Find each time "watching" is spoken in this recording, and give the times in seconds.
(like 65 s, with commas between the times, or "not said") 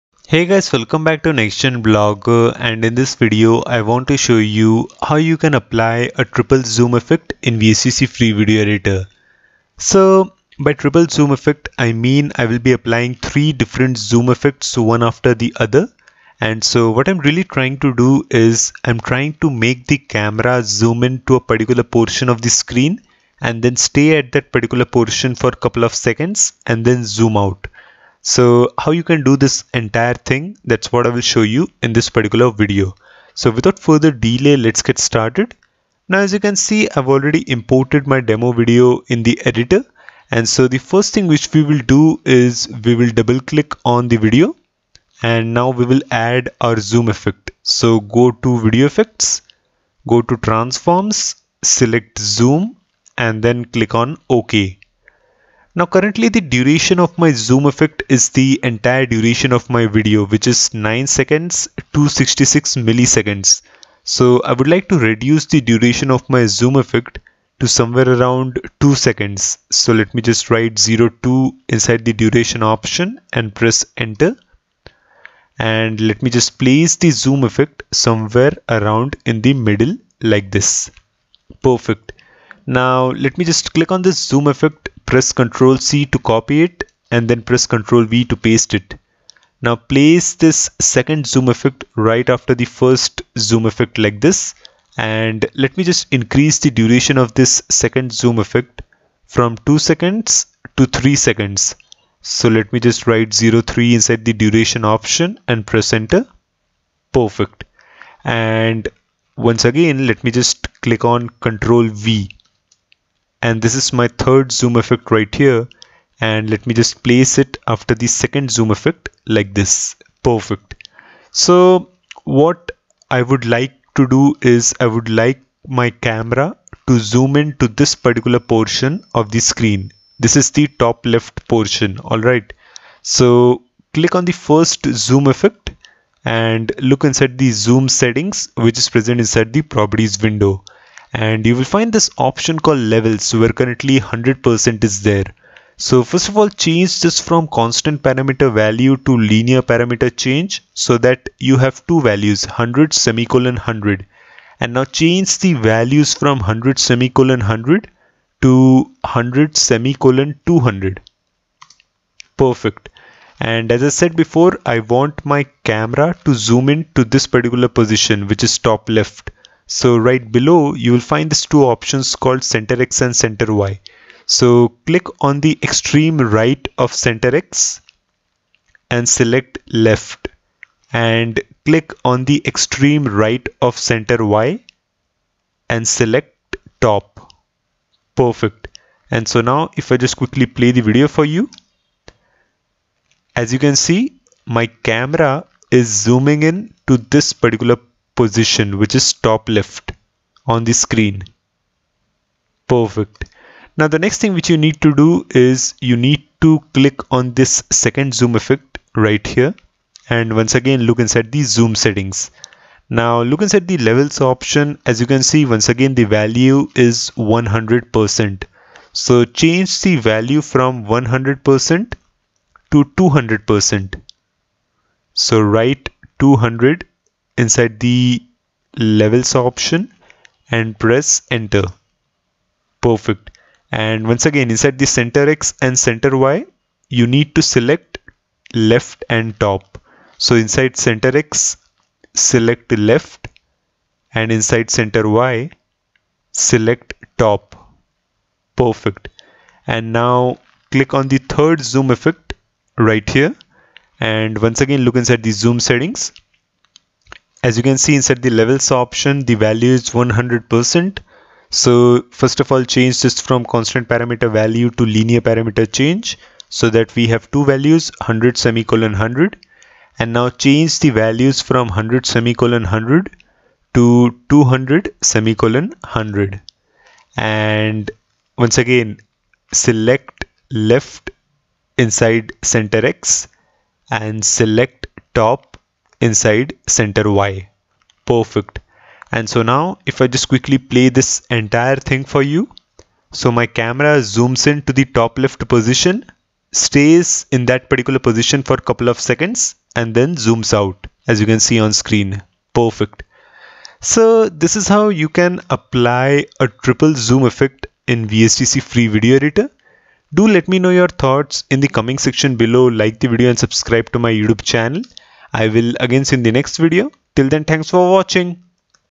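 317 s.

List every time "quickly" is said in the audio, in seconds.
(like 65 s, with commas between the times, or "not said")
190 s, 290 s.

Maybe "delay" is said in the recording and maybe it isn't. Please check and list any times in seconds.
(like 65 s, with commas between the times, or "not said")
34 s.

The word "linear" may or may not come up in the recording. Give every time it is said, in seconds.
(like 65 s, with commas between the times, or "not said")
149 s, 264 s.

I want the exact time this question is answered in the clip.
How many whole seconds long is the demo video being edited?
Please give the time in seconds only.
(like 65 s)
60 s.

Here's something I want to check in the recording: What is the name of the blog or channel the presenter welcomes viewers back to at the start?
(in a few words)
NextGen blog.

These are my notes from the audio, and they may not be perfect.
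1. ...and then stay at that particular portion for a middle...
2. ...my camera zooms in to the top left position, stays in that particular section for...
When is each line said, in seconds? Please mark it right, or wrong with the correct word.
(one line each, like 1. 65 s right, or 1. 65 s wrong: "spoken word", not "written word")
1. 23 s wrong: "couple", not "middle"
2. 293 s wrong: "position", not "section".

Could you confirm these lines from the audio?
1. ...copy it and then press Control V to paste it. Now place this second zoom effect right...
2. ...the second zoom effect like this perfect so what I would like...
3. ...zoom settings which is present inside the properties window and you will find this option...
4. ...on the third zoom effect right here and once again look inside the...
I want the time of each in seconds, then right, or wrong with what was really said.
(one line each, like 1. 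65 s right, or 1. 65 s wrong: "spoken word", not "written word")
1. 86 s right
2. 117 s right
3. 137 s right
4. 250 s right.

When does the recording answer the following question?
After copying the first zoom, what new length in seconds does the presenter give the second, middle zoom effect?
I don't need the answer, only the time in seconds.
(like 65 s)
100 s.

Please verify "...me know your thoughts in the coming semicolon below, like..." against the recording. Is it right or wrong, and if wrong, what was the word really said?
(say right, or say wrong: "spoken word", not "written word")
wrong: "section", not "semicolon".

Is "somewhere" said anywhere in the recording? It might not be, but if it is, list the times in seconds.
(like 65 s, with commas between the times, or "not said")
67 s, 77 s.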